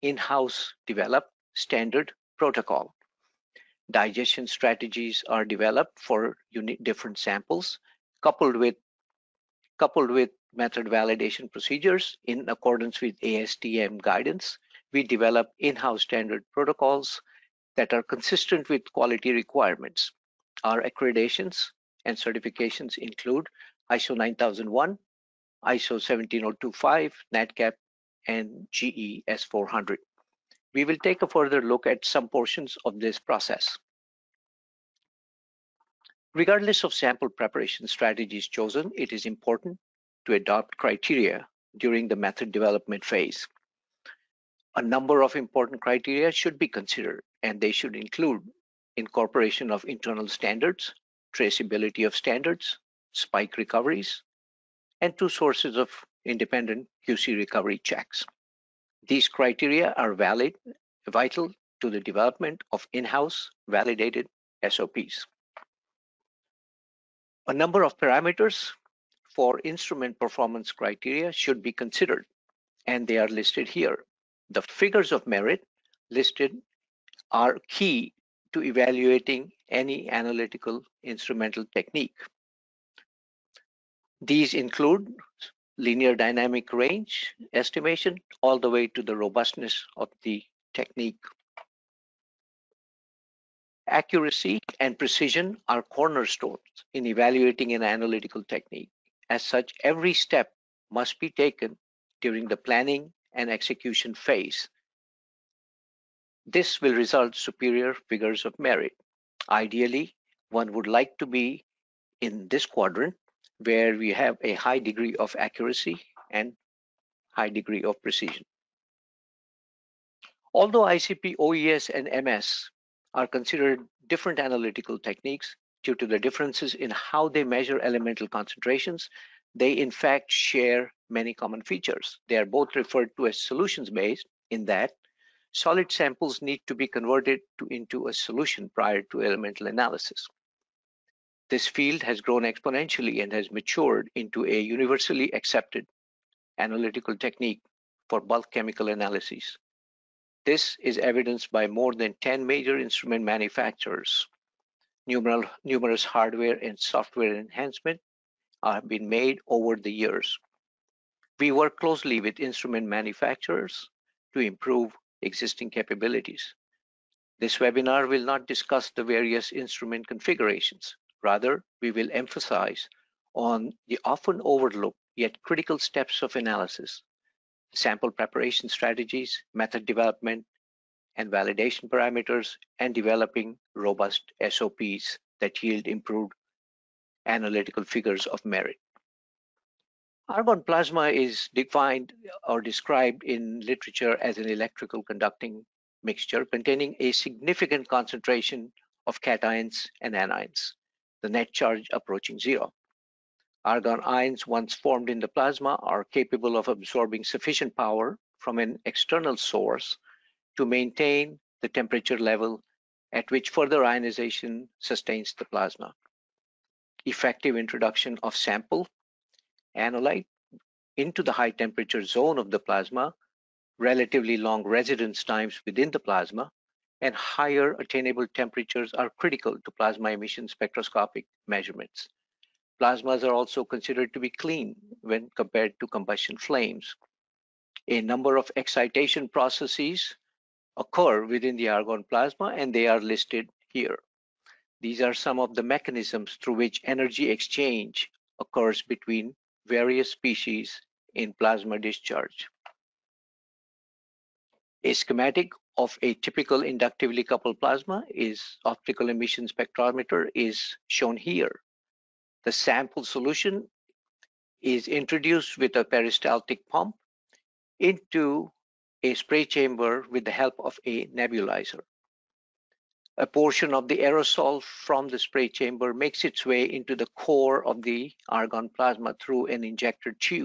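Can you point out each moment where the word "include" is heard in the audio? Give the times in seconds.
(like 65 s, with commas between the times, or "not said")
22 s, 47 s, 84 s.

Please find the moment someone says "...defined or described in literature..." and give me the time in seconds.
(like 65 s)
191 s.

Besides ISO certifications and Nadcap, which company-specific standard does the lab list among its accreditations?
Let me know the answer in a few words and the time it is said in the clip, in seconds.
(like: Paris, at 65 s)
GE S400, at 28 s.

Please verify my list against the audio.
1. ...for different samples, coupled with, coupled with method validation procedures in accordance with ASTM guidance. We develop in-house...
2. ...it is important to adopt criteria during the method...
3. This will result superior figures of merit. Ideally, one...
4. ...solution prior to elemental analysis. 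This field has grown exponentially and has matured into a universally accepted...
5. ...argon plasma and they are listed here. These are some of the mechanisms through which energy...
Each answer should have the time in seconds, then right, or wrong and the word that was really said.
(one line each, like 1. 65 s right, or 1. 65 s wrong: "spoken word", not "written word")
1. 5 s right
2. 38 s right
3. 106 s right
4. 138 s right
5. 241 s right.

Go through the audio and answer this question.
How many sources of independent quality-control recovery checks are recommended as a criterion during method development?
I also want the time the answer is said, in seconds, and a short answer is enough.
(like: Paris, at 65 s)
2, at 55 s.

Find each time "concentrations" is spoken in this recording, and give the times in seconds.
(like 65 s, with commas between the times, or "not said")
128 s, 197 s.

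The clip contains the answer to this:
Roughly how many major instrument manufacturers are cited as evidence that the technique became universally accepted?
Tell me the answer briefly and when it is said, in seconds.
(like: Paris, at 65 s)
More than 10, at 151 s.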